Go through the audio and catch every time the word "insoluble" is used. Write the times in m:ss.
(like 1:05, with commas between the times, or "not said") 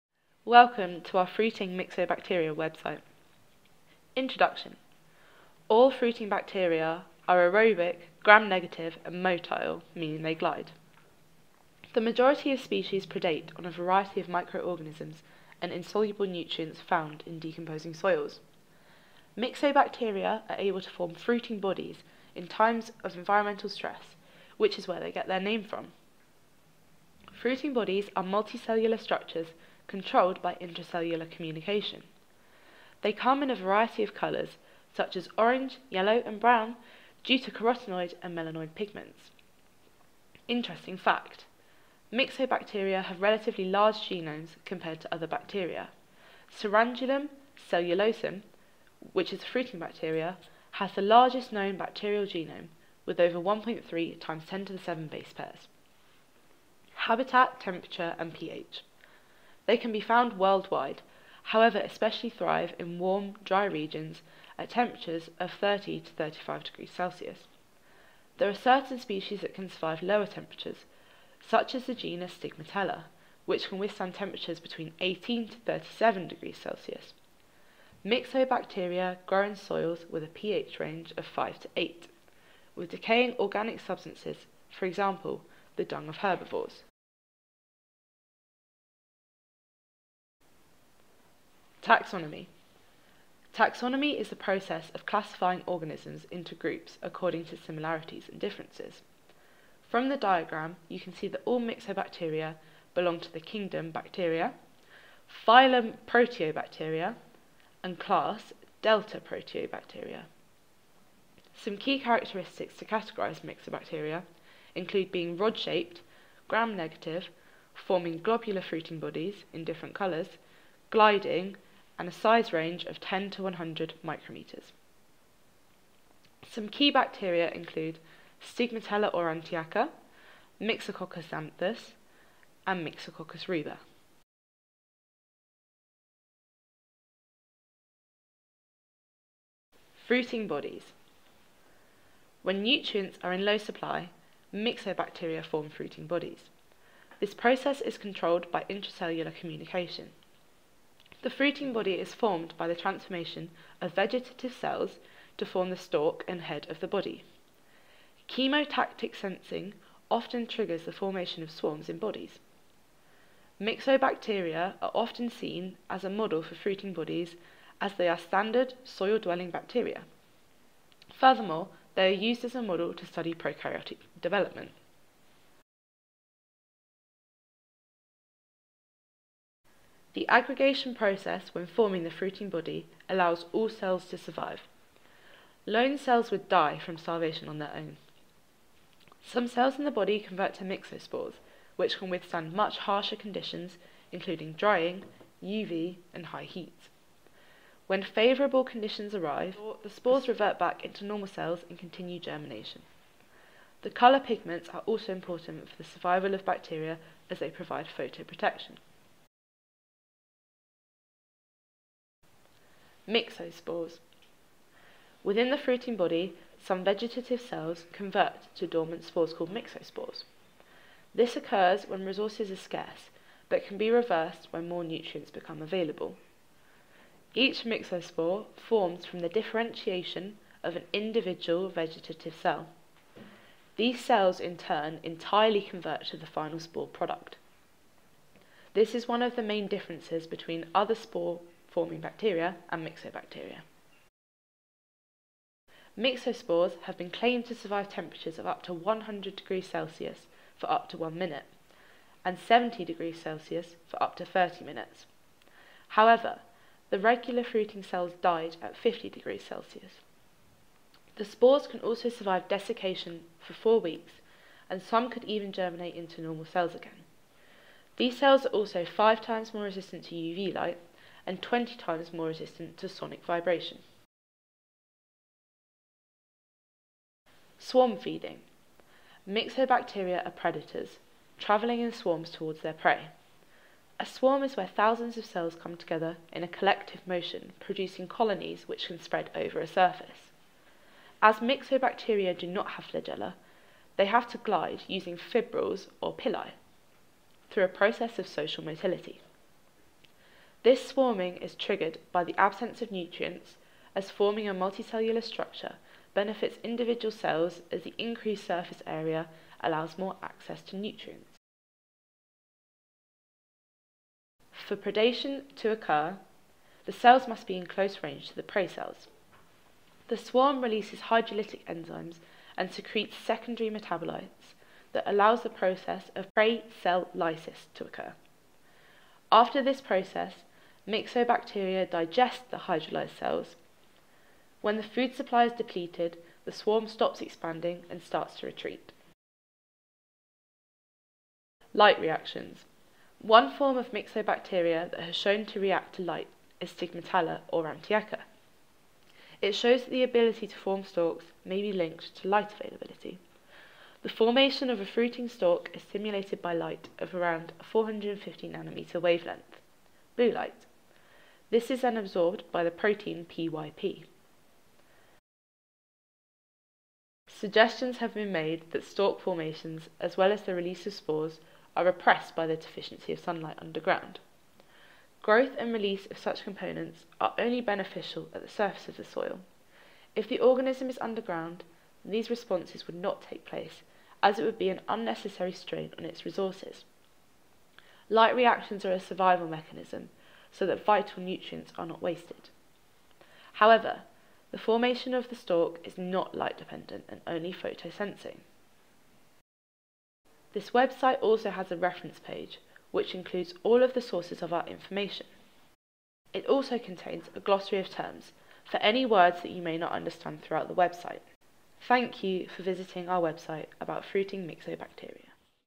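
0:15.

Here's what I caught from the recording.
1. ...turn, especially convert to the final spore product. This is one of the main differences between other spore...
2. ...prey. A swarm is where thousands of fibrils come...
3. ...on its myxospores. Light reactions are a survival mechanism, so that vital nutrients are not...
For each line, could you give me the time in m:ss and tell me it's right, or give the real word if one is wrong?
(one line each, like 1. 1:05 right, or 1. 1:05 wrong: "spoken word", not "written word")
1. 3:54 wrong: "entirely", not "especially"
2. 4:42 wrong: "cells", not "fibrils"
3. 6:25 wrong: "resources", not "myxospores".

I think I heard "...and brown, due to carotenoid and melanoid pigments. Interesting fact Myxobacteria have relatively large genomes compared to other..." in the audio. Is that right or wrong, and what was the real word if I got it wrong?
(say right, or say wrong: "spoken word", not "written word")
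right.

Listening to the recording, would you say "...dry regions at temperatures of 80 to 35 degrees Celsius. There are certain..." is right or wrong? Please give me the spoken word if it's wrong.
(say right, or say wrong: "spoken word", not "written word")
wrong: "30", not "80".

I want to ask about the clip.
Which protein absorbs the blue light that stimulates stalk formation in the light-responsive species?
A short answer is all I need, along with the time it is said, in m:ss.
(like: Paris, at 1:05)
PYP, at 6:03.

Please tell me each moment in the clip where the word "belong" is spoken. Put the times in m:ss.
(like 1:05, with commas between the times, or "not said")
1:42.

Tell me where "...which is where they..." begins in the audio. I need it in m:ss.
0:24.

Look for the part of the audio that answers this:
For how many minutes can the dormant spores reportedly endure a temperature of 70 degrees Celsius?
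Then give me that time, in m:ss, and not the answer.
4:14.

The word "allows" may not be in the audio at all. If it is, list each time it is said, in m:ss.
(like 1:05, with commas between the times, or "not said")
3:03, 5:09, 5:25.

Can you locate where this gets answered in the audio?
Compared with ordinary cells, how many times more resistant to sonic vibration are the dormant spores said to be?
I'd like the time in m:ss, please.
4:31.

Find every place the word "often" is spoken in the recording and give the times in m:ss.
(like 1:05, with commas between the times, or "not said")
2:40, 2:44.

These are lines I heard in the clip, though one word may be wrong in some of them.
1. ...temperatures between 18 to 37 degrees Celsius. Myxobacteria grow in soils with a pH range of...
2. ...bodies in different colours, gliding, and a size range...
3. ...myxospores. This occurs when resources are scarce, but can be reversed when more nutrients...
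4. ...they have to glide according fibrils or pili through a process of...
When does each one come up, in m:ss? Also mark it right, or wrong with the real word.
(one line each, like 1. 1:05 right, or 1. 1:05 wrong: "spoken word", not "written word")
1. 1:14 right
2. 1:58 right
3. 3:39 right
4. 4:53 wrong: "using", not "according".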